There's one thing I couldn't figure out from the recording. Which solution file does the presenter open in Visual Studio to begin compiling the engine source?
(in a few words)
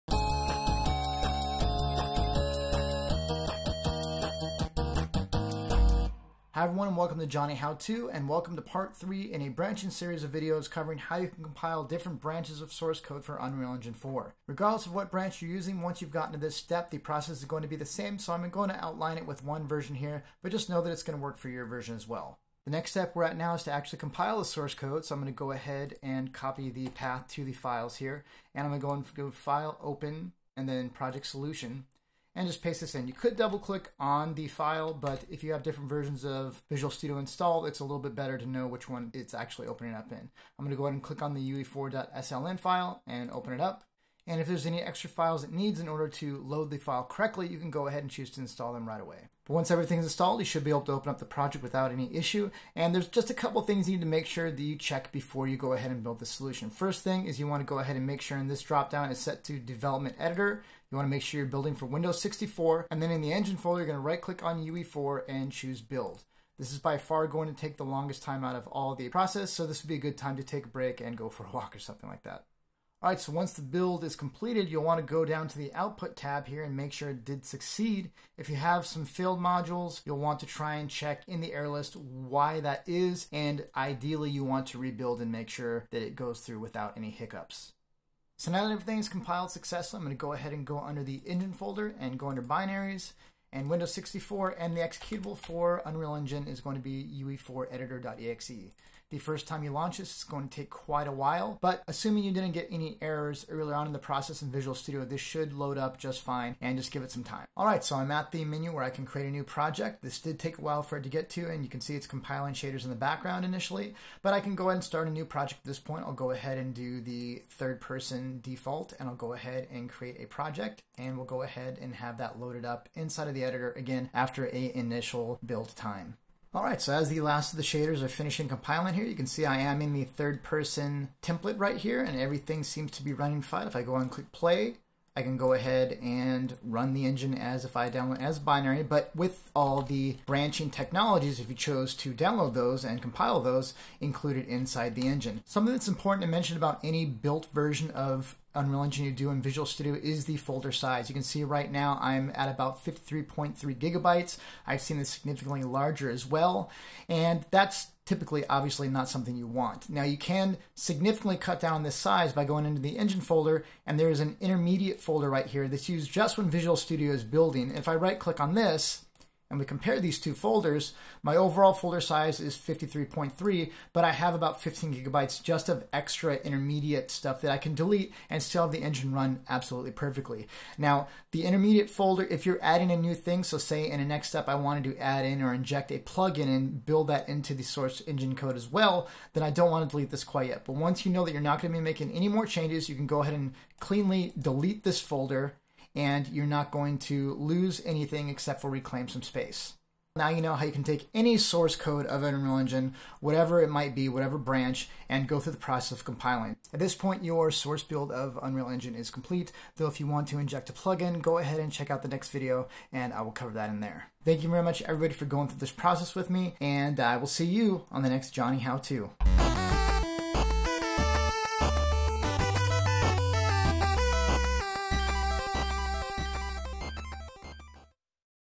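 UE4.sln.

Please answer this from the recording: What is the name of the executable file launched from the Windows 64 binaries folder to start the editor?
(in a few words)
UE4Editor.exe.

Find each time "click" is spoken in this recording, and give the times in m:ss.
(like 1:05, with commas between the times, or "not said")
0:33, 0:41, 1:04, 2:14, 2:48.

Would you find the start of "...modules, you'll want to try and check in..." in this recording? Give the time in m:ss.
1:19.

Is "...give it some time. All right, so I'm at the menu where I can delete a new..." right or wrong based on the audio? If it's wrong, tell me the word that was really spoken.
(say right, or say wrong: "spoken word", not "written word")
wrong: "create", not "delete".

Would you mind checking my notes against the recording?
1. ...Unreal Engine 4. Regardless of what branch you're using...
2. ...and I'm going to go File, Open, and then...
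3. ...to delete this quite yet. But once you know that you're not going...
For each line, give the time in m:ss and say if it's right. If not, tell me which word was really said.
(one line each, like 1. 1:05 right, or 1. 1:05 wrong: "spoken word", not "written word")
1. 0:13 right
2. 0:28 right
3. 3:09 right.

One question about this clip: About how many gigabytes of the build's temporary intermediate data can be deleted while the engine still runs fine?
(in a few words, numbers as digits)
15 gigabytes.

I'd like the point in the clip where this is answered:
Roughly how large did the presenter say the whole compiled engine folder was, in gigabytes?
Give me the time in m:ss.
2:32.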